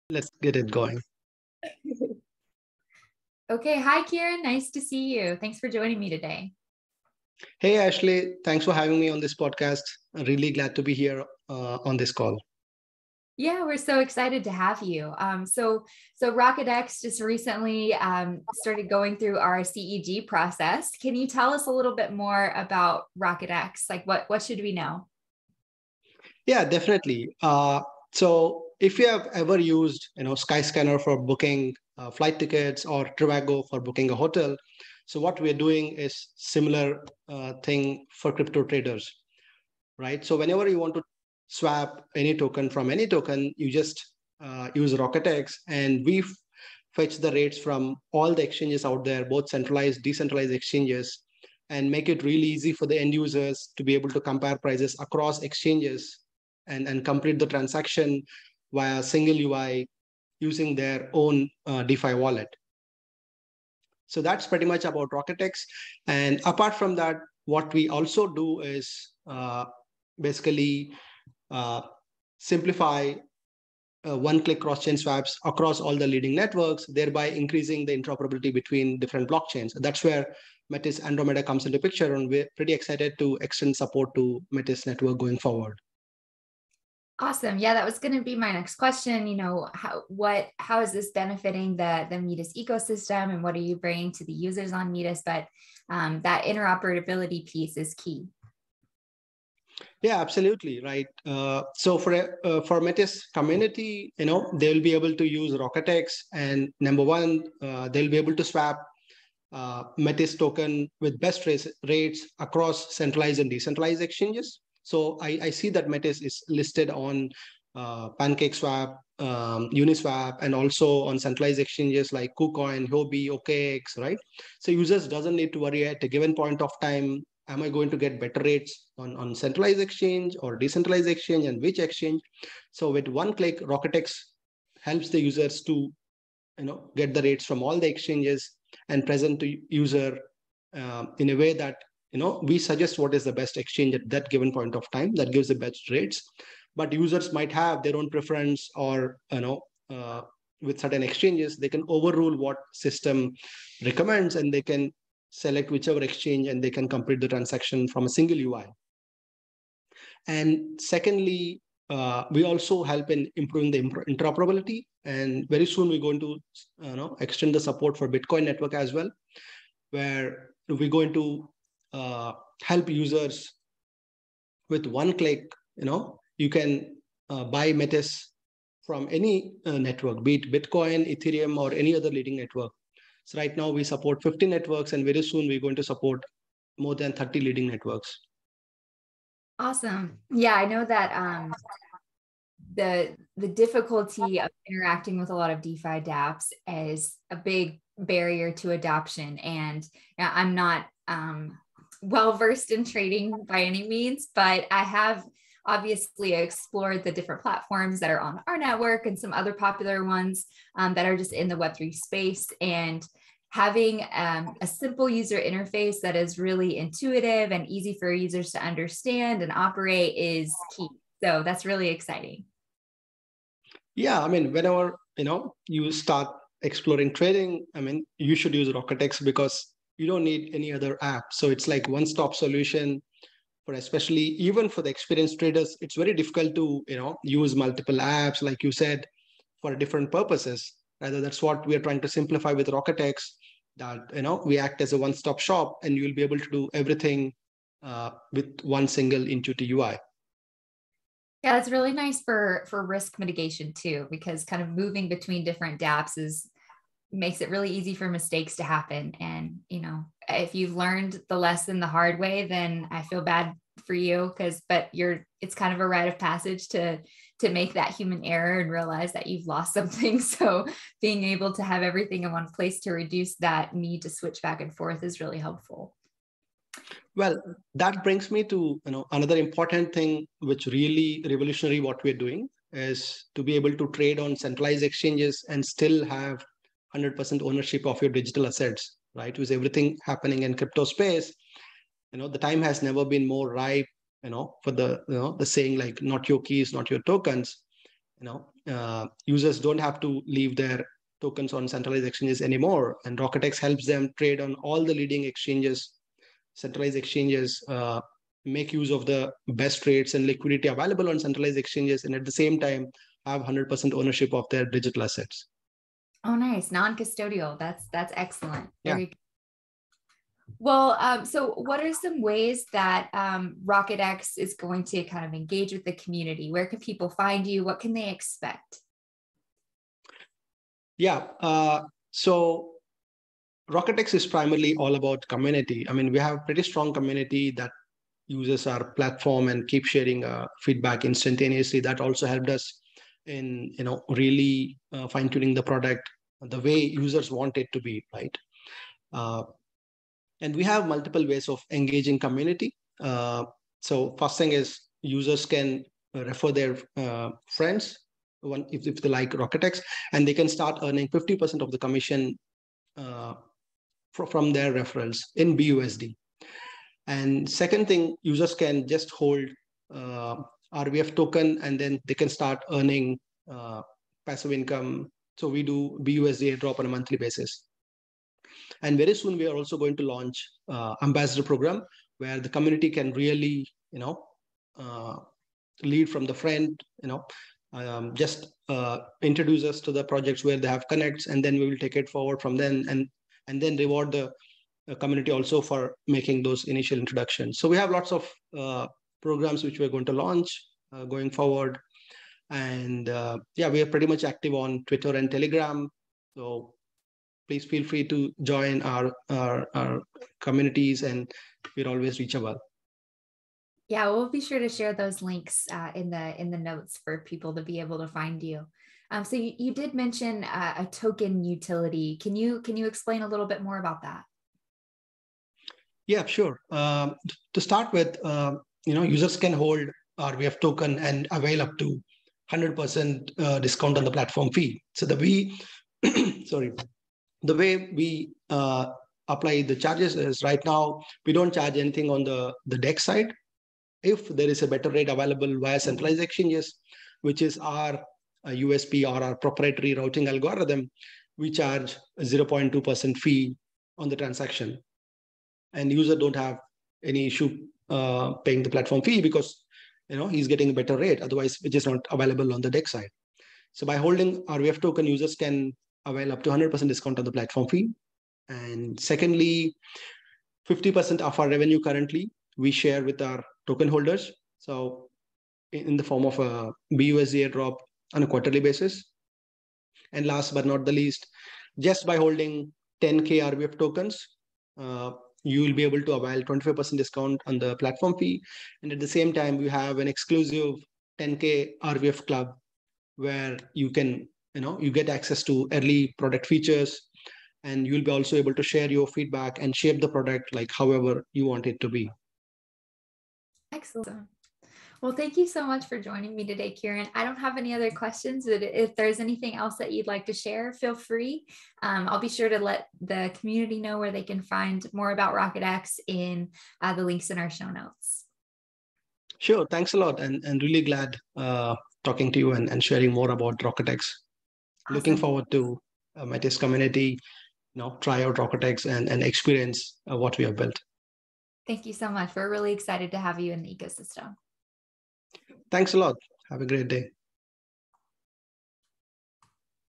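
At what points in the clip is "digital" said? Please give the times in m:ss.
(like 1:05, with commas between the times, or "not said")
4:48, 5:14.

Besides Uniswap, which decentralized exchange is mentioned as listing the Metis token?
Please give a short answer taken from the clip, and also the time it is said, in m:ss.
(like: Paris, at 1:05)
PancakeSwap, at 1:58.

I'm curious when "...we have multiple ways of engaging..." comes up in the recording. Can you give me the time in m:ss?
5:50.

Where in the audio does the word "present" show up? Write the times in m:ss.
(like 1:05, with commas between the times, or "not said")
2:19.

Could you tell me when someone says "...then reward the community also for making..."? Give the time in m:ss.
6:33.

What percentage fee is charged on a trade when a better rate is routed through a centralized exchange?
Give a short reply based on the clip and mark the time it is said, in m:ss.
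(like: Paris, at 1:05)
0.2%, at 7:32.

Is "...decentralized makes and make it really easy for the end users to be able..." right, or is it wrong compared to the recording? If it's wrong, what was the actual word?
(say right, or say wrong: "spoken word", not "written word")
wrong: "exchanges", not "makes".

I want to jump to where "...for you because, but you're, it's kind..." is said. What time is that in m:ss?
4:23.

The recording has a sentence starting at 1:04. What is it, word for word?
So that's pretty much about RocketX.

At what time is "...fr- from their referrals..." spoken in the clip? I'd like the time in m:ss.
6:04.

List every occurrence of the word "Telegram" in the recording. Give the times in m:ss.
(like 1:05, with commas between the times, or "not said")
6:45.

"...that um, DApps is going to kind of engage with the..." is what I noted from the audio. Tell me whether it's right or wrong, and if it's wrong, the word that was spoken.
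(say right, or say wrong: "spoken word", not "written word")
wrong: "RocketX", not "DApps".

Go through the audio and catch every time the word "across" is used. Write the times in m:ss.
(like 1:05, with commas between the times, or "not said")
0:54, 1:15, 1:52.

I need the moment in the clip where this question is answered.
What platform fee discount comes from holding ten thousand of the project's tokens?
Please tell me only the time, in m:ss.
8:06.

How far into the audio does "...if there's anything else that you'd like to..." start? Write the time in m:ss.
8:28.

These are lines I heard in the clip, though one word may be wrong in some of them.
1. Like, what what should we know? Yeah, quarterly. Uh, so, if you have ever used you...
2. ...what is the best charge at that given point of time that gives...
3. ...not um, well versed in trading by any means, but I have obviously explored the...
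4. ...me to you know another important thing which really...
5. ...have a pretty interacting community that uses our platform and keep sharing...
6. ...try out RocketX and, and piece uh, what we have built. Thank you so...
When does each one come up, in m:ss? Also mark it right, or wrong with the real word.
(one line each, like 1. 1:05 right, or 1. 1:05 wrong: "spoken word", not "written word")
1. 0:23 wrong: "definitely", not "quarterly"
2. 2:22 wrong: "exchange", not "charge"
3. 3:20 right
4. 4:38 right
5. 5:36 wrong: "strong", not "interacting"
6. 8:48 wrong: "experience", not "piece".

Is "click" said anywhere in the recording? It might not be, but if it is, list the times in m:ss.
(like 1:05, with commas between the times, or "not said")
1:14, 2:13, 2:55.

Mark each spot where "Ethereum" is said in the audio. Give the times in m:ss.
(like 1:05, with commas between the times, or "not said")
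3:01.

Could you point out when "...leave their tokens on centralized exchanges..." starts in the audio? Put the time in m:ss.
5:00.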